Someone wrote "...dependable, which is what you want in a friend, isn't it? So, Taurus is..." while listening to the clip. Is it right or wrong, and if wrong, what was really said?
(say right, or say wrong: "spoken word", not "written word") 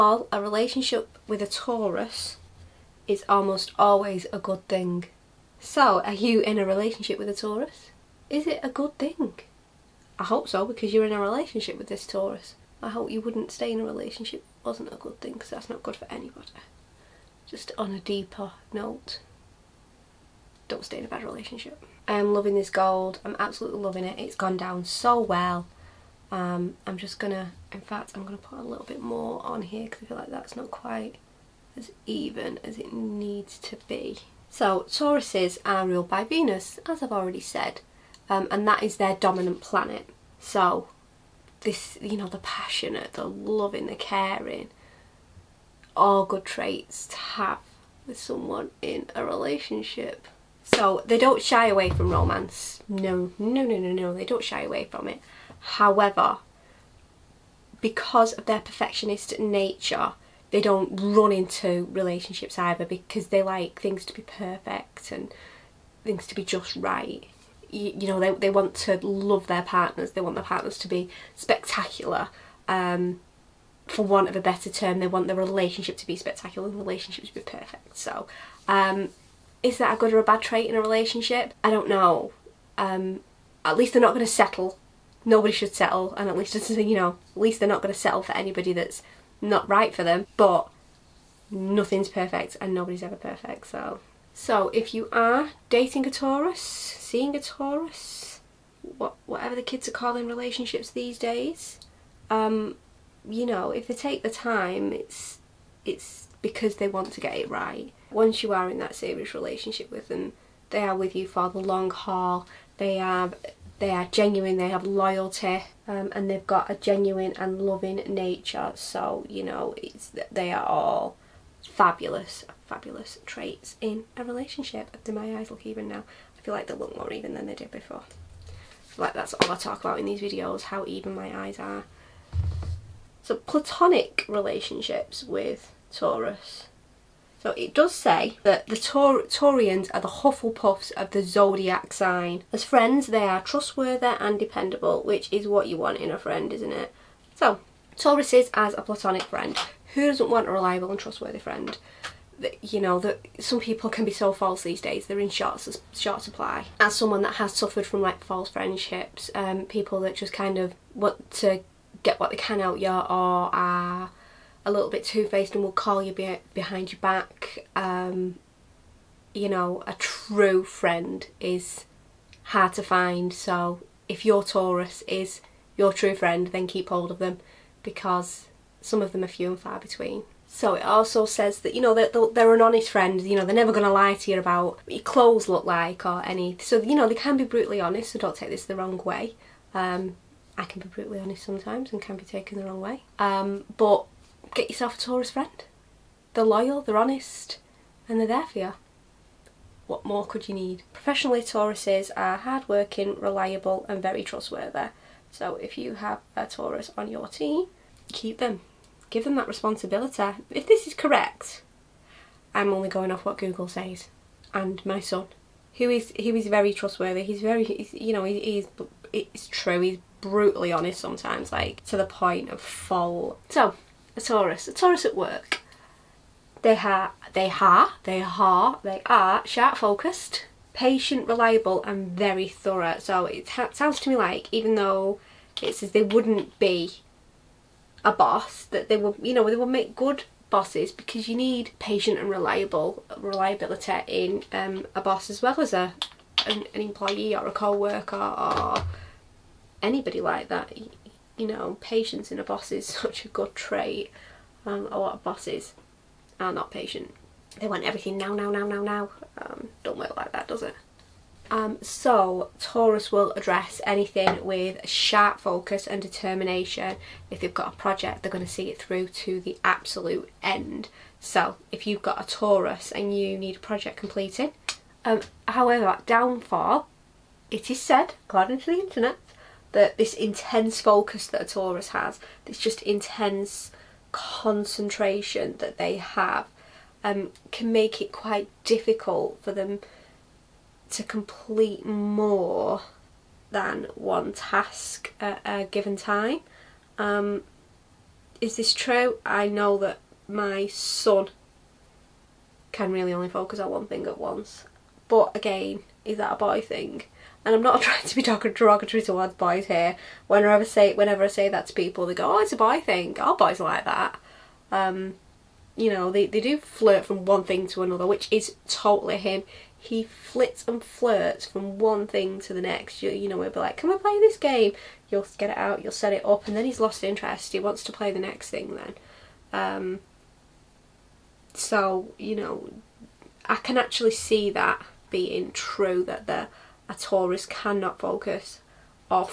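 right.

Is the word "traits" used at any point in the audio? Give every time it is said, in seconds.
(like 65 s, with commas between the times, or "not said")
46 s, 80 s, 123 s, 253 s.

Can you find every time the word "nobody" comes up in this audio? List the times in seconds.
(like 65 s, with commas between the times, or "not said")
85 s, 92 s.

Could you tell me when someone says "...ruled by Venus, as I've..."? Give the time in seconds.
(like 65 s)
35 s.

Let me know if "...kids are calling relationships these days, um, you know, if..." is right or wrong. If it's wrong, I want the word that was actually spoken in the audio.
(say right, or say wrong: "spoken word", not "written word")
right.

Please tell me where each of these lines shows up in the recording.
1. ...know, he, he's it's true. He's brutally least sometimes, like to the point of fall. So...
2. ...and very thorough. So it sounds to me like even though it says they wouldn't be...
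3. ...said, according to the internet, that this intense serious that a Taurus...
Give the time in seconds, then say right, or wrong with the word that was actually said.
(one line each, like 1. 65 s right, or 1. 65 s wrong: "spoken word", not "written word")
1. 218 s wrong: "honest", not "least"
2. 231 s right
3. 277 s wrong: "focus", not "serious".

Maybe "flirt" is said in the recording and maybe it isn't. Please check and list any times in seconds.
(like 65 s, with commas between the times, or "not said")
316 s, 320 s.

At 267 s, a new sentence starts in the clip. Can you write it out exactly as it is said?
If they've got a project, they're going to see it through to the absolute end.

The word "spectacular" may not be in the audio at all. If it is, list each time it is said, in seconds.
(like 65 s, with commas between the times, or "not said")
71 s, 76 s.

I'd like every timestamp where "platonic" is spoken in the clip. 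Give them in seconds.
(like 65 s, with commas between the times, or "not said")
133 s, 148 s.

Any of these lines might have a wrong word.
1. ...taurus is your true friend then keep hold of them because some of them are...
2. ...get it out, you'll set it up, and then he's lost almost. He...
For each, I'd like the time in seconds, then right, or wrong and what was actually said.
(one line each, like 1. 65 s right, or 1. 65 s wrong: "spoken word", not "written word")
1. 174 s right
2. 325 s wrong: "interest", not "almost".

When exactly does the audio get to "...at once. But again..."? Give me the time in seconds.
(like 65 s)
304 s.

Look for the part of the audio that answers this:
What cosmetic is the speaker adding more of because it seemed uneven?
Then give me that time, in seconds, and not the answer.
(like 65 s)
22 s.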